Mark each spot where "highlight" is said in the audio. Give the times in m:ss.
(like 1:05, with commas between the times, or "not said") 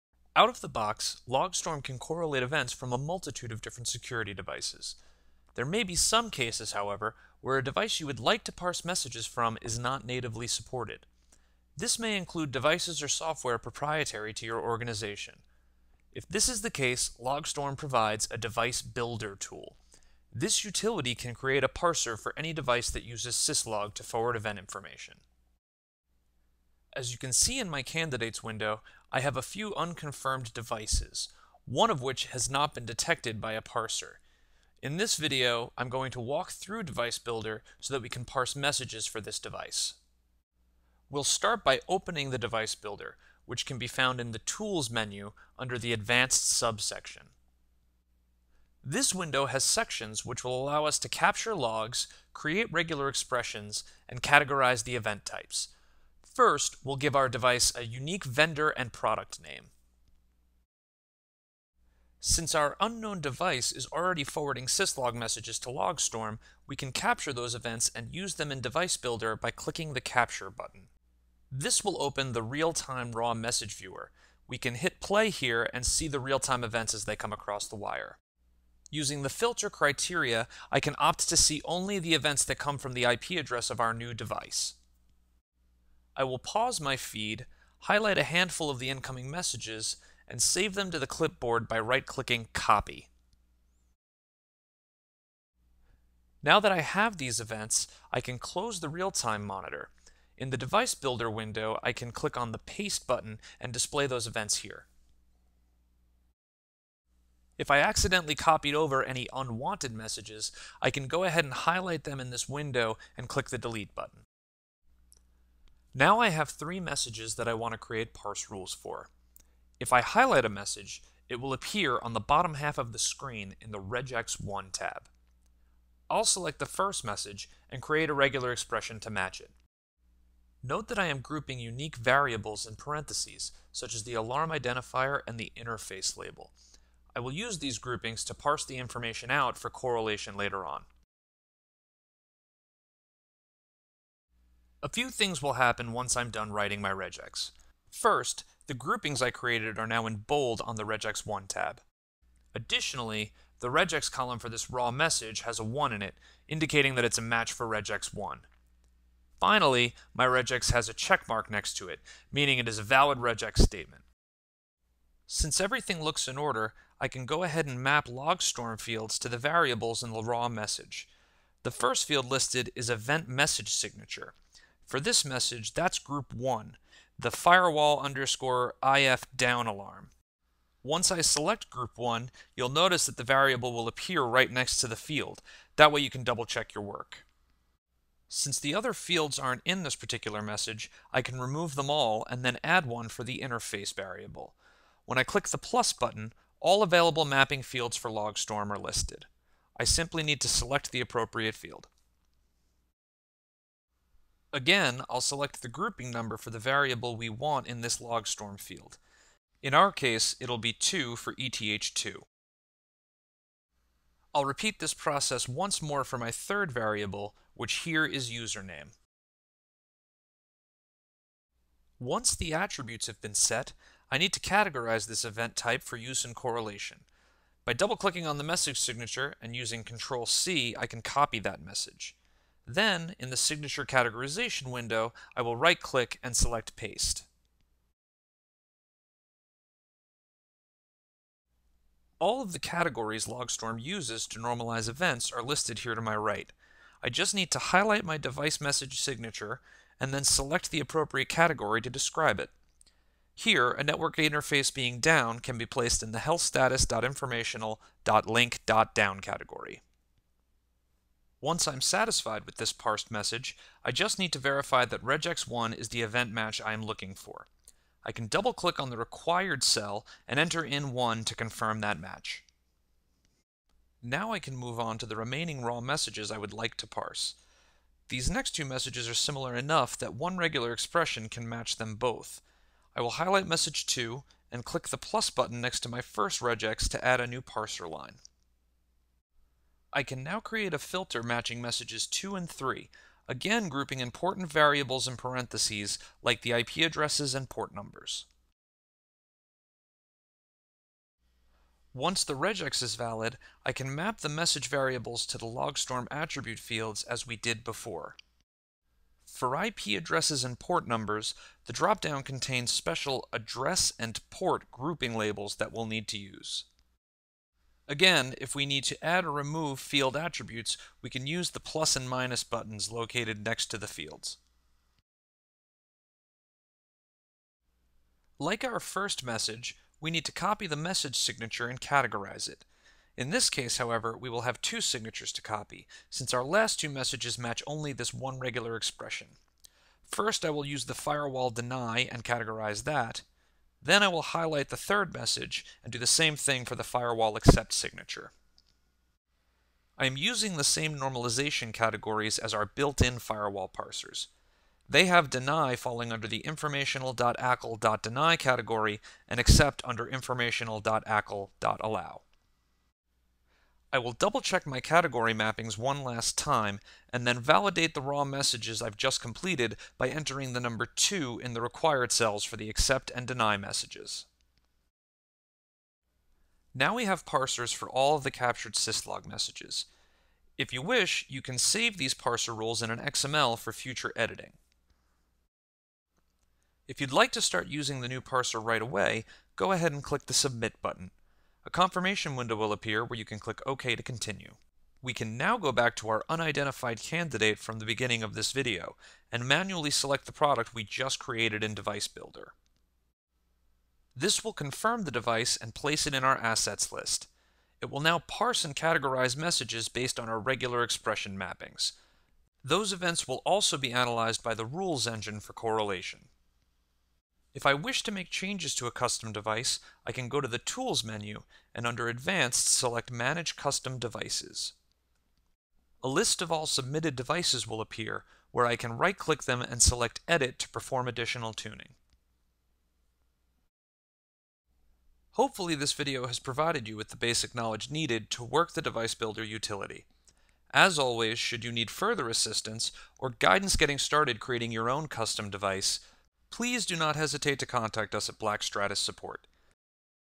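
1:27, 1:51, 2:00, 4:07, 4:43, 5:44.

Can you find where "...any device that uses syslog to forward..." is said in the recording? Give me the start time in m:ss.
0:22.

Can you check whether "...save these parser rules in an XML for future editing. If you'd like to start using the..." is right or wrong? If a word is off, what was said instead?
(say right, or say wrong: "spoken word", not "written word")
right.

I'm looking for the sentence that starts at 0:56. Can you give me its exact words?
First, we'll give our device a unique vendor and product name.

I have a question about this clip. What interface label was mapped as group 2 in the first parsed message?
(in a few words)
ETH2.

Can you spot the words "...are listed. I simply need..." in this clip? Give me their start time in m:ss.
3:18.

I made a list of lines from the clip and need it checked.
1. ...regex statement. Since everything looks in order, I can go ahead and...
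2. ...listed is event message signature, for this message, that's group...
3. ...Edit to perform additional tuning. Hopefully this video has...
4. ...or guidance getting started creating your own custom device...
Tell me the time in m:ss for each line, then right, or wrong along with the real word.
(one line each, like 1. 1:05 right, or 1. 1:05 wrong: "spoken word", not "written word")
1. 2:43 right
2. 2:52 right
3. 7:10 right
4. 7:23 right.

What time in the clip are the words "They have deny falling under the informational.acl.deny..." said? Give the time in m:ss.
5:54.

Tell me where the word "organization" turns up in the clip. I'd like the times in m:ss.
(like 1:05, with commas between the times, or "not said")
0:14.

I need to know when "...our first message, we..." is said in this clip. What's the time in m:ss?
5:28.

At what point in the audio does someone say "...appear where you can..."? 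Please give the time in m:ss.
6:32.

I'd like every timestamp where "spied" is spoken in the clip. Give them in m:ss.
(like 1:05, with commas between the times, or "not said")
not said.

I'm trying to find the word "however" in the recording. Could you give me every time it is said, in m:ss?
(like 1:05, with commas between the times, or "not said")
0:06, 5:33.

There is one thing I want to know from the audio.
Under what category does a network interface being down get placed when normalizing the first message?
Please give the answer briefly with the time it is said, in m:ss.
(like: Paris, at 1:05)
healthstatus.informational.link.down, at 4:16.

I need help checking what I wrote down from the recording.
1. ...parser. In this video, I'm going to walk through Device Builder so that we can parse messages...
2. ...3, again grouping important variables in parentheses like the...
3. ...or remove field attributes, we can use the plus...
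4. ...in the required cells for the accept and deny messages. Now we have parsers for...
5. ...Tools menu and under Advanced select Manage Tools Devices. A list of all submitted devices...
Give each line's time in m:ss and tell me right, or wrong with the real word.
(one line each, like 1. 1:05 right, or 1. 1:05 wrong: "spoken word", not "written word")
1. 0:33 right
2. 4:52 right
3. 5:19 right
4. 6:11 right
5. 7:00 wrong: "Custom", not "Tools".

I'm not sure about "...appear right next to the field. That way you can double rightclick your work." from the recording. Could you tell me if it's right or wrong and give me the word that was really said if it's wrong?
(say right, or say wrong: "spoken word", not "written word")
wrong: "check", not "rightclick".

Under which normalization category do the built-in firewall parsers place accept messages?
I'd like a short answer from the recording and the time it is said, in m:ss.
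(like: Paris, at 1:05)
informational.acl.allow, at 6:00.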